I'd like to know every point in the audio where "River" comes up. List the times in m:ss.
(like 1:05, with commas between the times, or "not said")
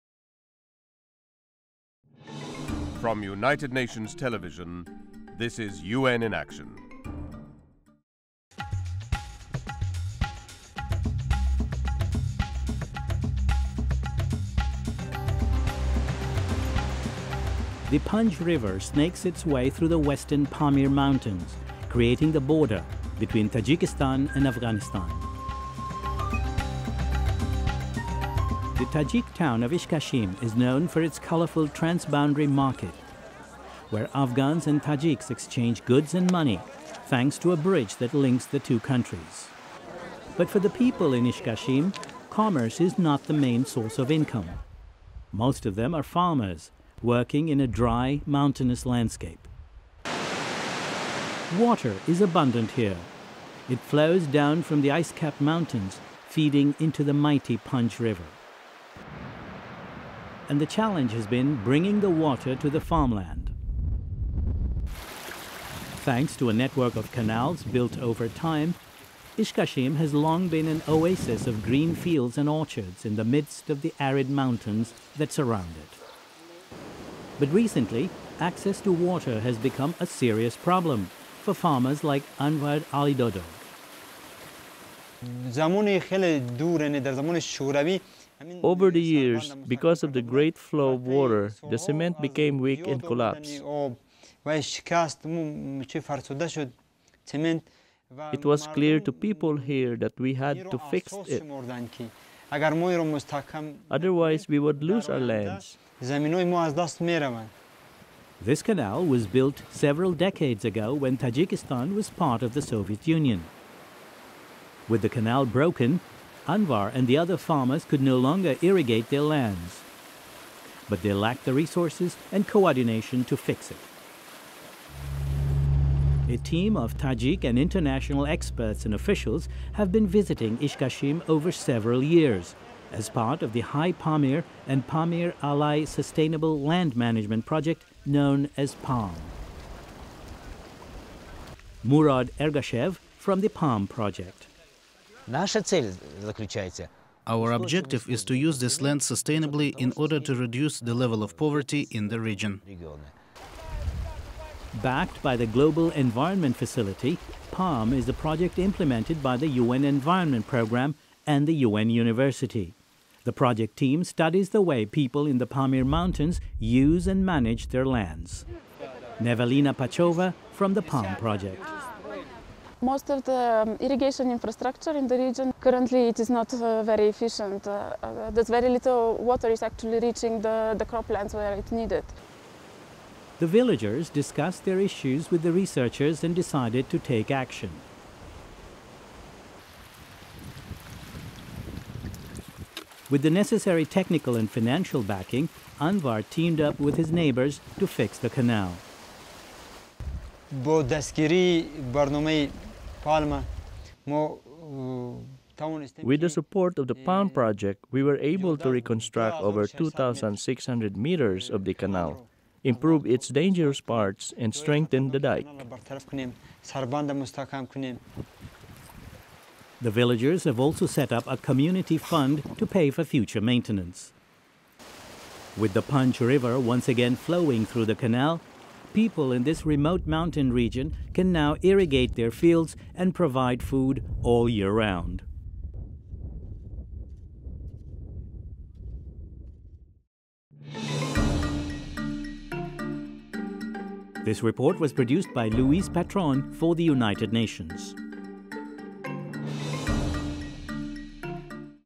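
0:18, 0:57, 3:46.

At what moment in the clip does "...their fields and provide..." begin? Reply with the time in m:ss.
3:52.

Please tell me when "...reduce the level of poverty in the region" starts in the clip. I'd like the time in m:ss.
2:30.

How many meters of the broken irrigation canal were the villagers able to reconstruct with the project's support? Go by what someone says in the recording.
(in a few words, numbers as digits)
2,600 meters.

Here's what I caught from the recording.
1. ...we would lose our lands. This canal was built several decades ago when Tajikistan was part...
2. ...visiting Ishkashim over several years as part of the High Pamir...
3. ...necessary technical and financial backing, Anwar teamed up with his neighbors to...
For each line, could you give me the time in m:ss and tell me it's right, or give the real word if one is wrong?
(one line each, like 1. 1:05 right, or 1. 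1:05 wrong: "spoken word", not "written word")
1. 1:44 right
2. 2:10 right
3. 3:13 right.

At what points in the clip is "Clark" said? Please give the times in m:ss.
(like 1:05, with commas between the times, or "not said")
not said.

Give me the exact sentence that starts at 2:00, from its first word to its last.
But they lacked the resources and coordination to fix it.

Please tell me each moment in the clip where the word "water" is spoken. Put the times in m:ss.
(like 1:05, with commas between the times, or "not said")
0:51, 1:02, 1:18, 1:31, 2:59.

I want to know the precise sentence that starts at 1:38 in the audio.
It was clear to people here that we had to fix it.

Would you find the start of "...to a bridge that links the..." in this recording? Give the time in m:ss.
0:37.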